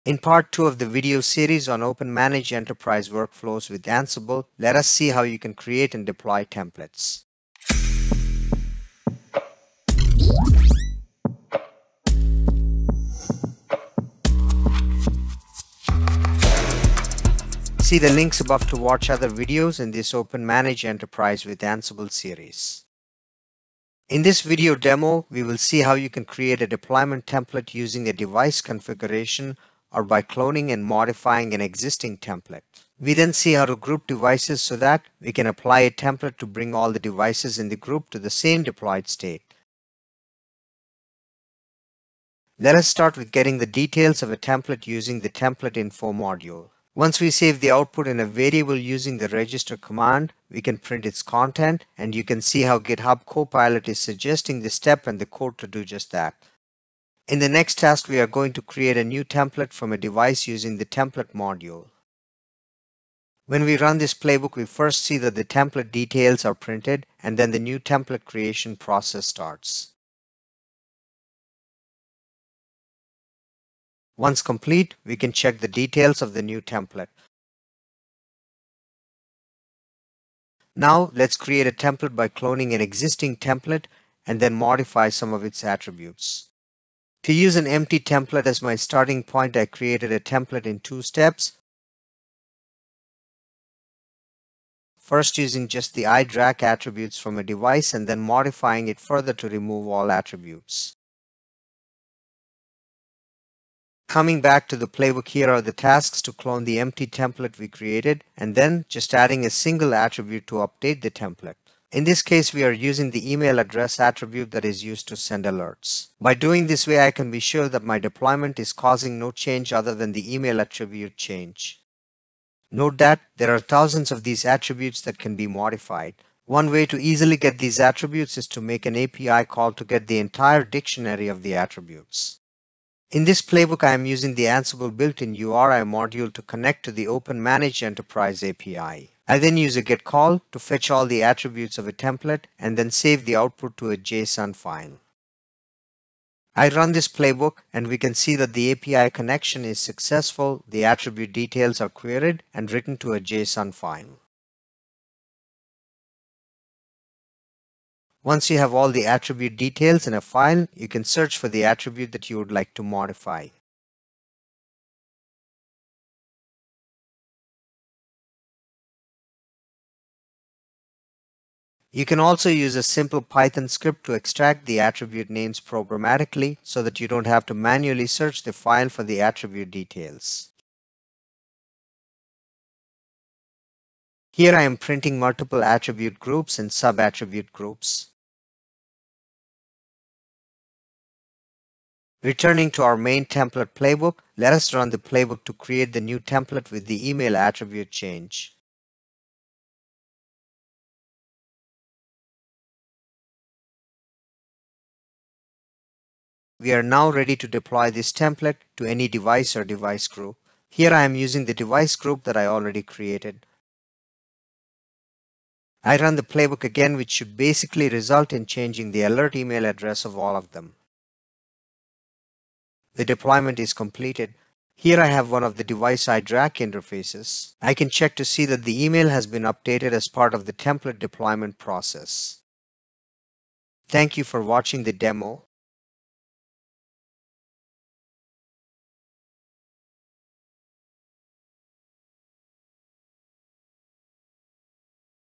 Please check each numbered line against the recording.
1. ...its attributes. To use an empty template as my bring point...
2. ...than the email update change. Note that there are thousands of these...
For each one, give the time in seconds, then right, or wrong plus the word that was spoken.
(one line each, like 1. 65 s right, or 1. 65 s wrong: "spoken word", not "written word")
1. 85 s wrong: "starting", not "bring"
2. 119 s wrong: "attribute", not "update".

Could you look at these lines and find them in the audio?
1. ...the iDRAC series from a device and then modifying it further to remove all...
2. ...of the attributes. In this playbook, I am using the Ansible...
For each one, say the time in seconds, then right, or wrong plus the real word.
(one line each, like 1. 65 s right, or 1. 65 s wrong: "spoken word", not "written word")
1. 95 s wrong: "attributes", not "series"
2. 131 s right.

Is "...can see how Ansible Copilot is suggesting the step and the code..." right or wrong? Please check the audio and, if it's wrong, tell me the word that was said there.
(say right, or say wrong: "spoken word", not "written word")
wrong: "GitHub", not "Ansible".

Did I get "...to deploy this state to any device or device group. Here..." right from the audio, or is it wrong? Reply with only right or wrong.
wrong.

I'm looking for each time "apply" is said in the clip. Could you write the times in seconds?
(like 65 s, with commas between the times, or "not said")
35 s.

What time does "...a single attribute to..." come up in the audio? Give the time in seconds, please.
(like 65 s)
109 s.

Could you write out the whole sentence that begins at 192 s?
Returning to our main template playbook, let us run the playbook to create the new template with the email attribute change.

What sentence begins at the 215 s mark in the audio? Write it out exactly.
I run the playbook again which should basically result in changing the alert email address of all of them.